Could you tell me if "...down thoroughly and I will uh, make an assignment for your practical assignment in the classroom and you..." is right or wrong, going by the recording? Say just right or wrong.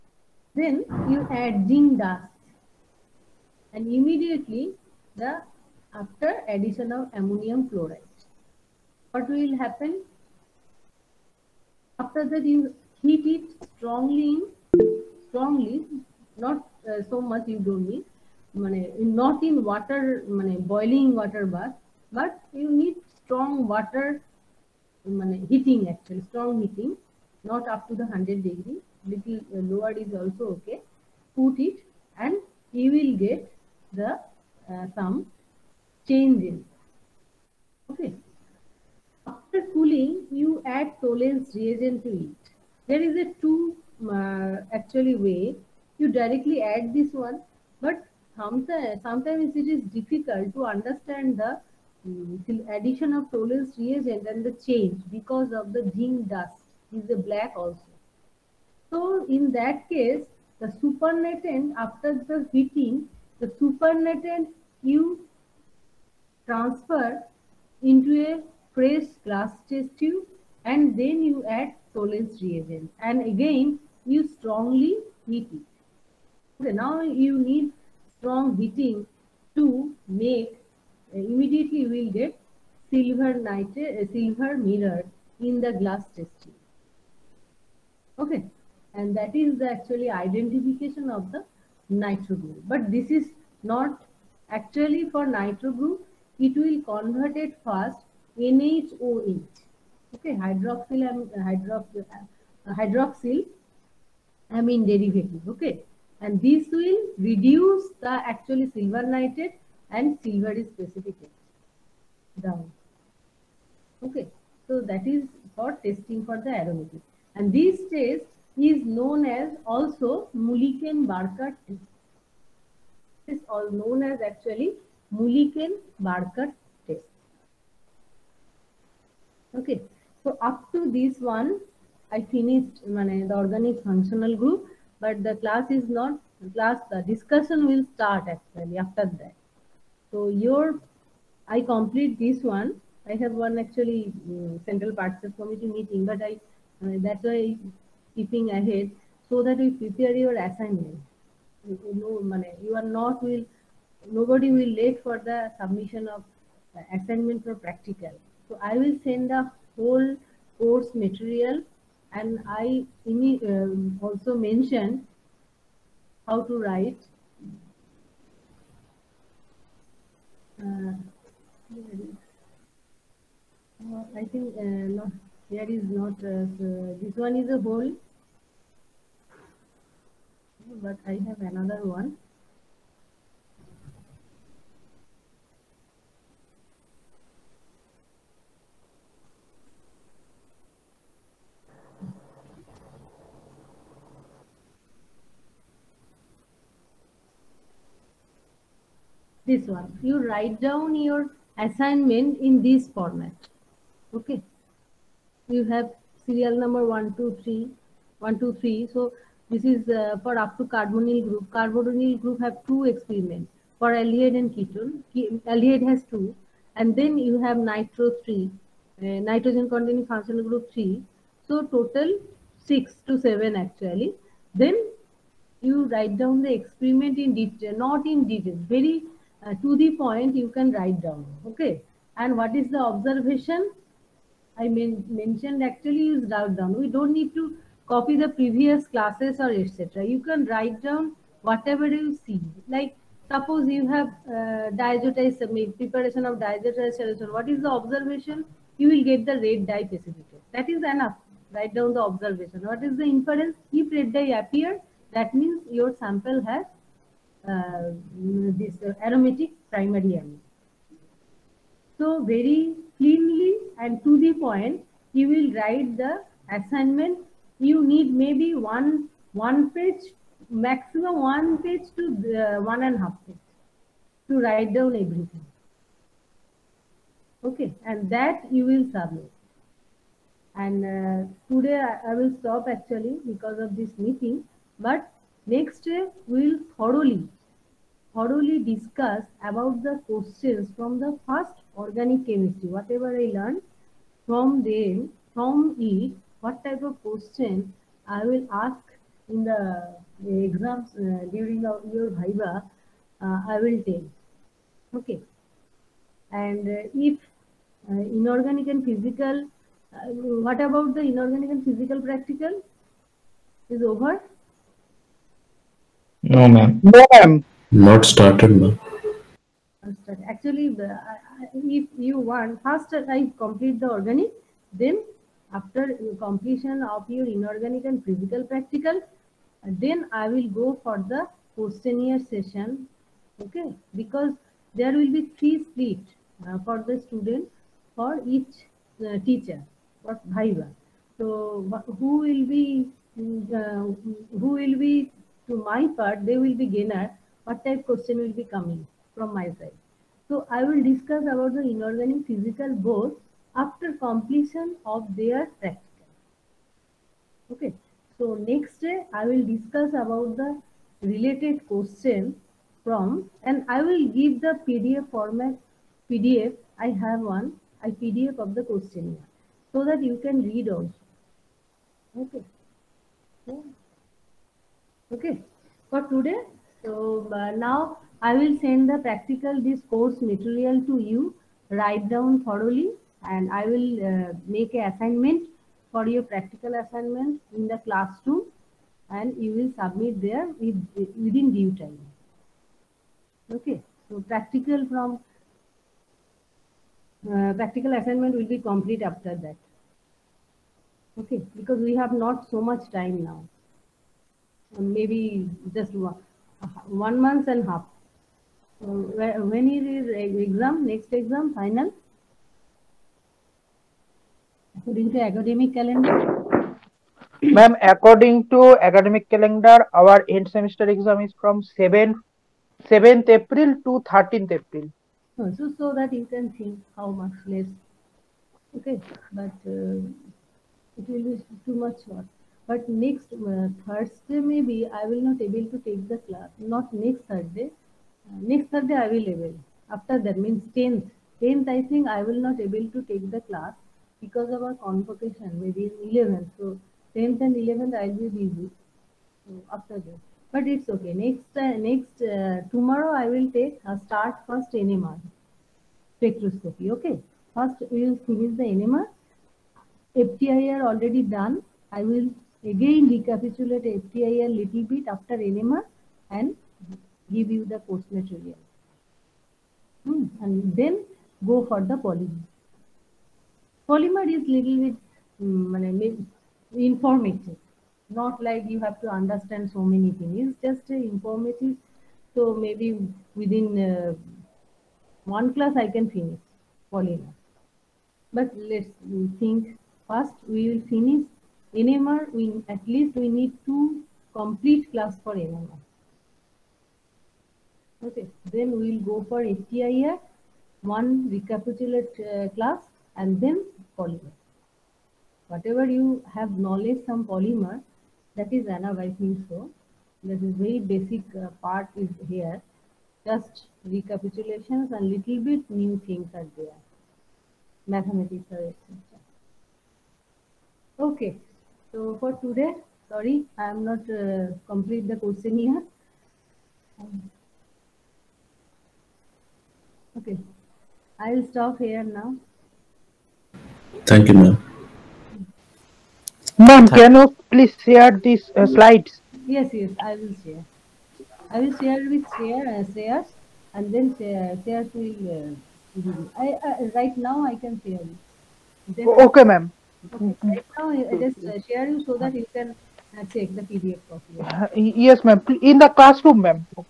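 right.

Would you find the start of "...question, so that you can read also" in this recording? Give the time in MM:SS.
06:08.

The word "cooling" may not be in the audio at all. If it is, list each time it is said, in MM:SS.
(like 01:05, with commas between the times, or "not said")
00:39.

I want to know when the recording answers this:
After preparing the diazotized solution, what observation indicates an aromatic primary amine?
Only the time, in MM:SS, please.
04:09.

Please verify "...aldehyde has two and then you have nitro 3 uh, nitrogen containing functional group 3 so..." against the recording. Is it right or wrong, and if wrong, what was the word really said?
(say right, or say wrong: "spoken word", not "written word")
right.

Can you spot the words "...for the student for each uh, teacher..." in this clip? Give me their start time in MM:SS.
05:36.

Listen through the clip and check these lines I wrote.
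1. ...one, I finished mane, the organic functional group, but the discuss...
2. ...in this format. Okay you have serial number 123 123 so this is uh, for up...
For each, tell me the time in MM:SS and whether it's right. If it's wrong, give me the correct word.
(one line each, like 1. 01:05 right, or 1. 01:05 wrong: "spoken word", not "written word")
1. 02:11 wrong: "class", not "discuss"
2. 03:22 right.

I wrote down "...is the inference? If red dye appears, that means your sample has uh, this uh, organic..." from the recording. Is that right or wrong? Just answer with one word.
wrong.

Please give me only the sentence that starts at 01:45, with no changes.
Okay, and this will reduce the actually silver nitrate and silver is precipitated down.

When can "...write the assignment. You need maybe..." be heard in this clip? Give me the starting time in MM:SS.
04:25.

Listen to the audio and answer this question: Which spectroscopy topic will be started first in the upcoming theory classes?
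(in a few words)
NMR spectroscopy.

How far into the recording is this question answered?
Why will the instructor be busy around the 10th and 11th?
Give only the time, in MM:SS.
07:24.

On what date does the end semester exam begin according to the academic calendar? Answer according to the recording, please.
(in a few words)
7th April.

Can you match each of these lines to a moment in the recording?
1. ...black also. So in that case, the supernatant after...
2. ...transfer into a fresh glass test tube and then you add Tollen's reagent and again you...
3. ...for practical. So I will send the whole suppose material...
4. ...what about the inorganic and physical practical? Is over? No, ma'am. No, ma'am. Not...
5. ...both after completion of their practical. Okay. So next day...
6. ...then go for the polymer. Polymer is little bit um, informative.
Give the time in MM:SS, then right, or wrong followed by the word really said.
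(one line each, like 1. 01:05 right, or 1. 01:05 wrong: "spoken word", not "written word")
1. 00:57 right
2. 01:06 right
3. 02:37 wrong: "course", not "suppose"
4. 05:10 right
5. 05:52 right
6. 07:50 right.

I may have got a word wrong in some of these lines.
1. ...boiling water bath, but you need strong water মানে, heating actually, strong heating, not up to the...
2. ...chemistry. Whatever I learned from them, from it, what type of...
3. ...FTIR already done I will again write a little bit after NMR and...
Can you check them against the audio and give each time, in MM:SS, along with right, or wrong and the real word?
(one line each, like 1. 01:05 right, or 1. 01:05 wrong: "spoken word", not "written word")
1. 00:20 right
2. 04:52 right
3. 07:40 wrong: "recapitulate", not "write".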